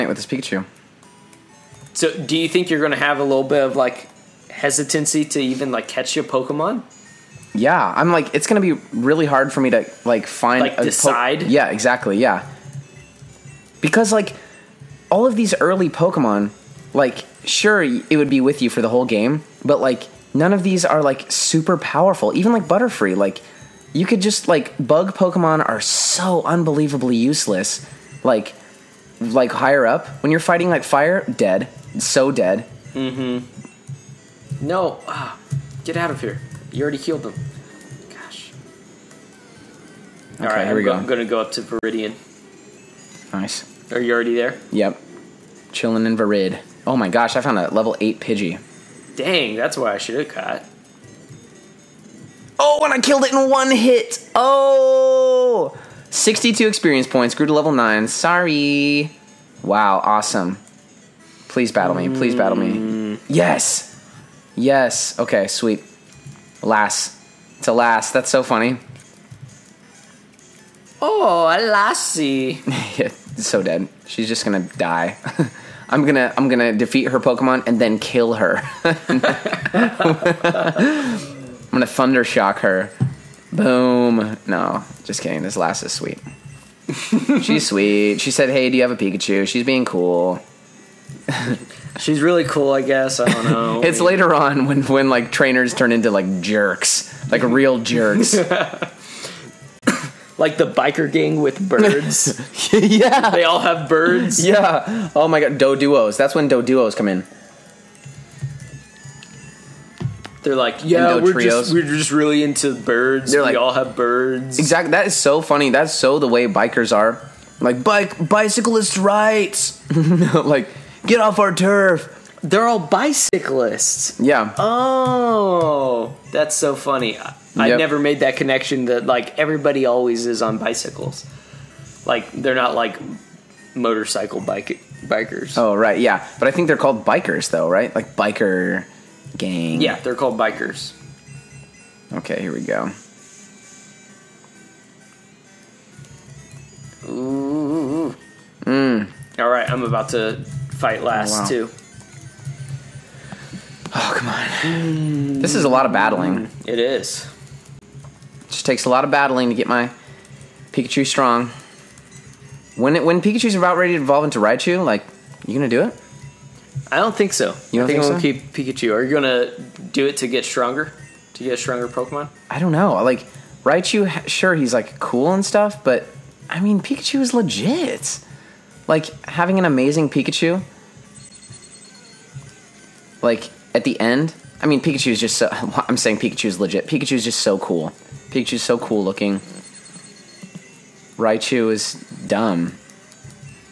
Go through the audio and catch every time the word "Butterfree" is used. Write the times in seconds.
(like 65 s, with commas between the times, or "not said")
22 s.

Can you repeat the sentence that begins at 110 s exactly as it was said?
They're like, yeah, we're just we're just really into birds.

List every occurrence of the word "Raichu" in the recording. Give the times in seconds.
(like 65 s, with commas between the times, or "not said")
164 s, 173 s, 191 s.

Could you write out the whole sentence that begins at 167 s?
You don't I think, think so?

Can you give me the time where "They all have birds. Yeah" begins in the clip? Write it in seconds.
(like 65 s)
103 s.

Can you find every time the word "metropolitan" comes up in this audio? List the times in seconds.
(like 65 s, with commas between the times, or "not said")
not said.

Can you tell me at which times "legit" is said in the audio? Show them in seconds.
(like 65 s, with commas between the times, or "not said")
177 s, 186 s.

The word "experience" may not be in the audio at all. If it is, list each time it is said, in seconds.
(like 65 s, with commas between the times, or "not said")
56 s.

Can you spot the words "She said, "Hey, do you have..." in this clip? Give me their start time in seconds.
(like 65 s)
88 s.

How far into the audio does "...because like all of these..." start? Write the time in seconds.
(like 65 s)
13 s.